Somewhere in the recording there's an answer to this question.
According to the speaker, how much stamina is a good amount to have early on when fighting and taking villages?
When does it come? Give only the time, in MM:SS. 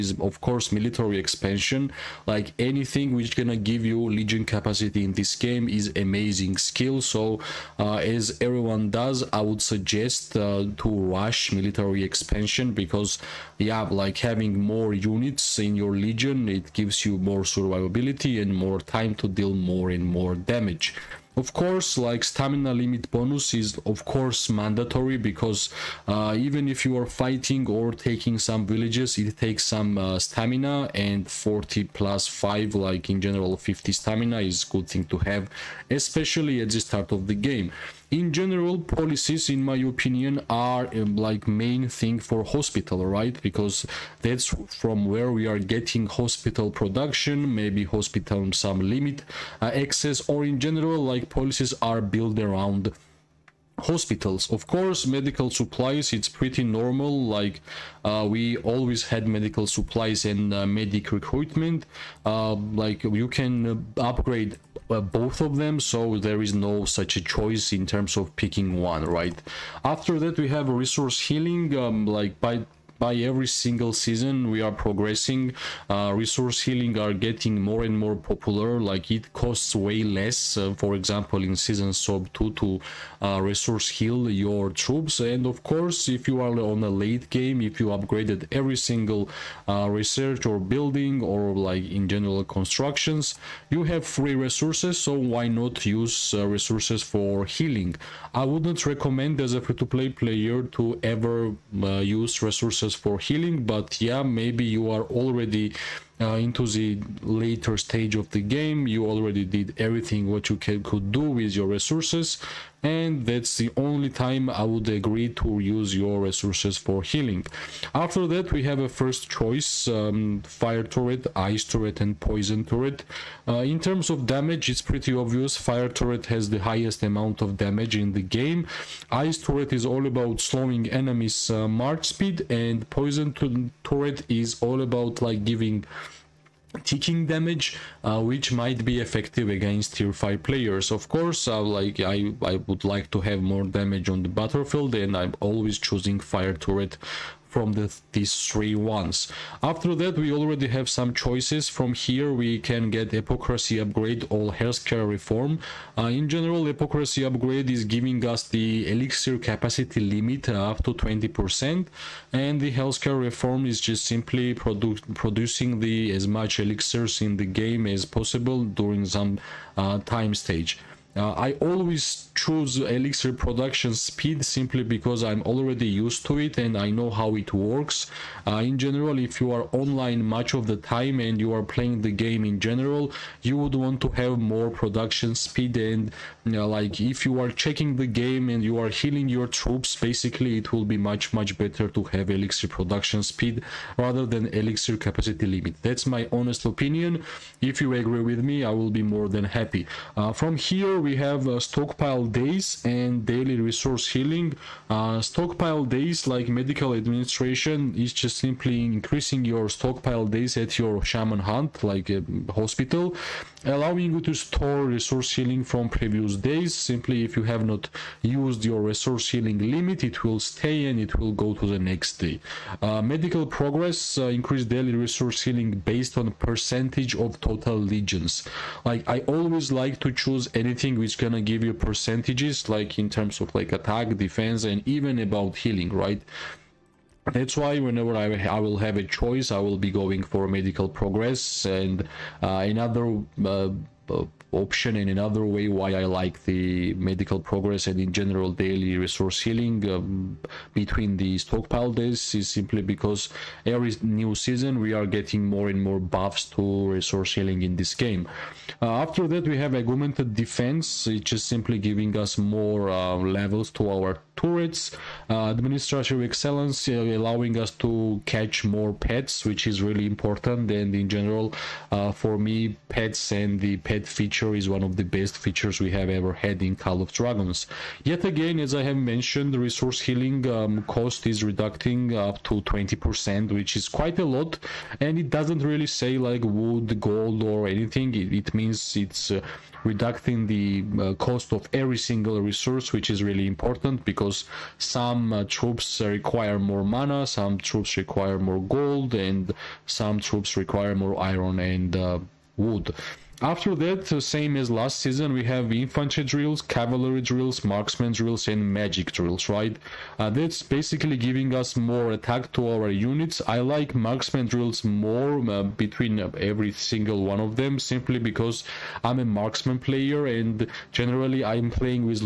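00:33.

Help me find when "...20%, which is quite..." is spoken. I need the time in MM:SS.
04:42.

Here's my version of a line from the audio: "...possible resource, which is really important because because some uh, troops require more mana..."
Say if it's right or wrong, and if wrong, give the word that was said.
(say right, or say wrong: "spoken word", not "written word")
wrong: "single", not "possible".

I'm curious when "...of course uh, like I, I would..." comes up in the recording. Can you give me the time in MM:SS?
02:20.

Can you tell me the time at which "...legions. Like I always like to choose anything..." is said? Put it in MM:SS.
03:47.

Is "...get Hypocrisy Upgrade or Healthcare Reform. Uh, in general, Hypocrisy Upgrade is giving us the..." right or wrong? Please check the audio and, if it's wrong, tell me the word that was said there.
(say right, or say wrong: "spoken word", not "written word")
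right.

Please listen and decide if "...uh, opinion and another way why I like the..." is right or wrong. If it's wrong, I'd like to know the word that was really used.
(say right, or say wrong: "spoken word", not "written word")
wrong: "option", not "opinion".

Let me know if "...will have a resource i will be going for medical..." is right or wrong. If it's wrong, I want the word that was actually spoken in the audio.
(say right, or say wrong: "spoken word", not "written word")
wrong: "choice", not "resource".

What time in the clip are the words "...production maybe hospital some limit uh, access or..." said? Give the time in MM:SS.
00:46.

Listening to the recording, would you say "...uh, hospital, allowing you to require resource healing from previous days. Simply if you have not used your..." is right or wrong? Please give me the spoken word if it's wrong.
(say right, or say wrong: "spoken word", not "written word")
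wrong: "store", not "require".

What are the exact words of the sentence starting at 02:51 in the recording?
Uh, I always choose Elixir production speed simply because I'm already used to it and I know how it works.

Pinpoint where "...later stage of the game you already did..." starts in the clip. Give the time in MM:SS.
01:47.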